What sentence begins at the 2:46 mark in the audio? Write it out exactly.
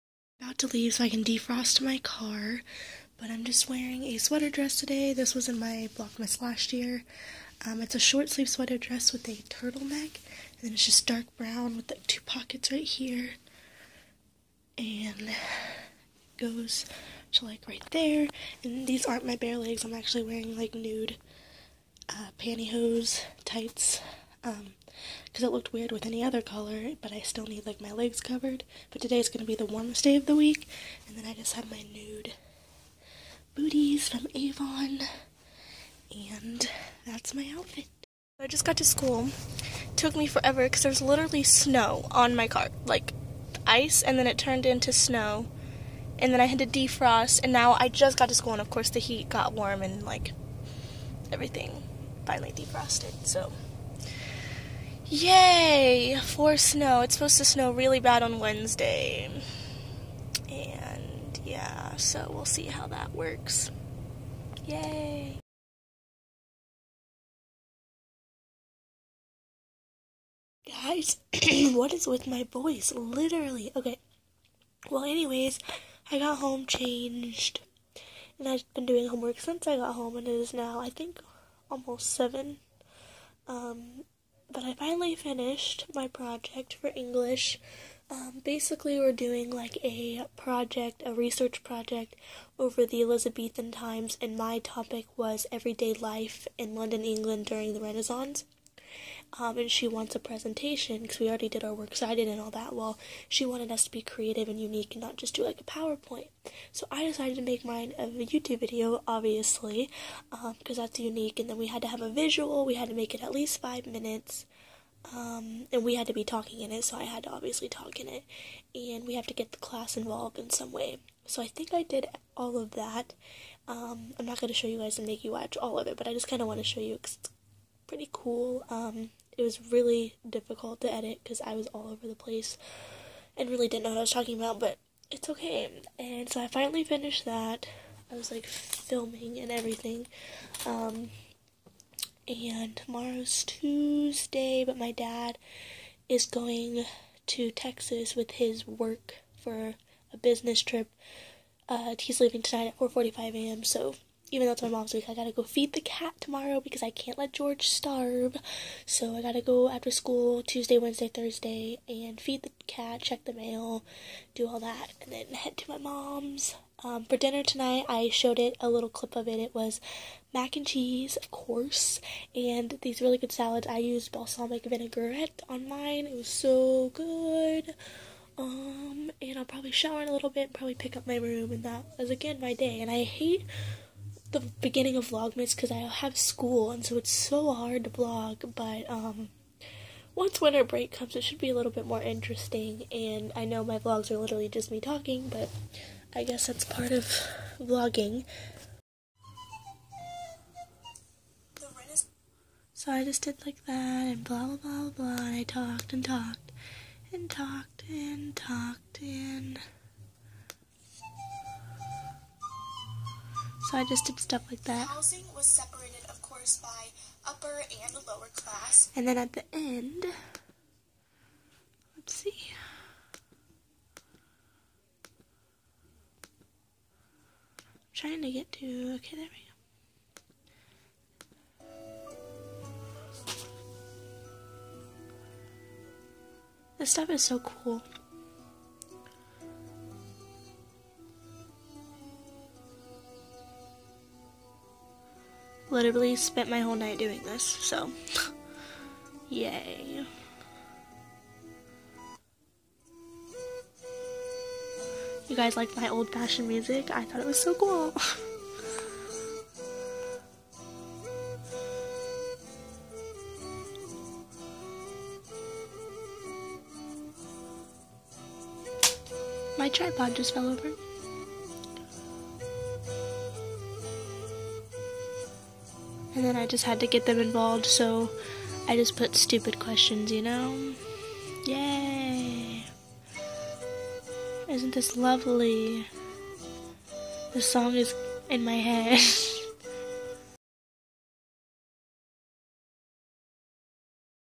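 Um, for dinner tonight, I showed it a little clip of it.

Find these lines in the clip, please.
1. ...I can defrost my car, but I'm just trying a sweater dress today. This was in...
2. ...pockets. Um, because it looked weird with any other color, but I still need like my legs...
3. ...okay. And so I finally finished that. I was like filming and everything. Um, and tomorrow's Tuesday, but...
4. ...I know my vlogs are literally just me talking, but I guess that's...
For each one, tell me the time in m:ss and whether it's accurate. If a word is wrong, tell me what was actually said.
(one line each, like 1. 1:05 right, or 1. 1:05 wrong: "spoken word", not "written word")
1. 0:01 wrong: "wearing", not "trying"
2. 0:23 wrong: "tights", not "pockets"
3. 2:15 right
4. 3:13 right.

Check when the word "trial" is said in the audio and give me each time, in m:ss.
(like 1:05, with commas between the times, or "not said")
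not said.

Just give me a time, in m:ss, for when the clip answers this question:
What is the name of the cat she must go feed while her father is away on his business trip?
2:37.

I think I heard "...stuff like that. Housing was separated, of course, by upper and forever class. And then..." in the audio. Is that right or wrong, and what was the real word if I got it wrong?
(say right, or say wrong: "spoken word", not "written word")
wrong: "lower", not "forever".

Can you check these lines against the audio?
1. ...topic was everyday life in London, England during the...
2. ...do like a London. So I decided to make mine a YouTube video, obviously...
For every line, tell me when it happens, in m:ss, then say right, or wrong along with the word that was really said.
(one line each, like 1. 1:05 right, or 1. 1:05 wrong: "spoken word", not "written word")
1. 1:34 right
2. 1:45 wrong: "PowerPoint", not "London".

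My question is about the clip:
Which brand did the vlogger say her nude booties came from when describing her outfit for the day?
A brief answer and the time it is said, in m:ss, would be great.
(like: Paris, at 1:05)
Avon, at 0:34.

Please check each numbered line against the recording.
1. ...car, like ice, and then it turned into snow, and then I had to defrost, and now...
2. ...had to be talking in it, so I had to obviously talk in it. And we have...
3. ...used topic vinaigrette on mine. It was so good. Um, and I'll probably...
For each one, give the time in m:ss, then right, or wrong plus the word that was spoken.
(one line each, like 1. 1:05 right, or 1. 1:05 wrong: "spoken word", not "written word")
1. 0:42 right
2. 1:55 right
3. 2:53 wrong: "balsamic", not "topic".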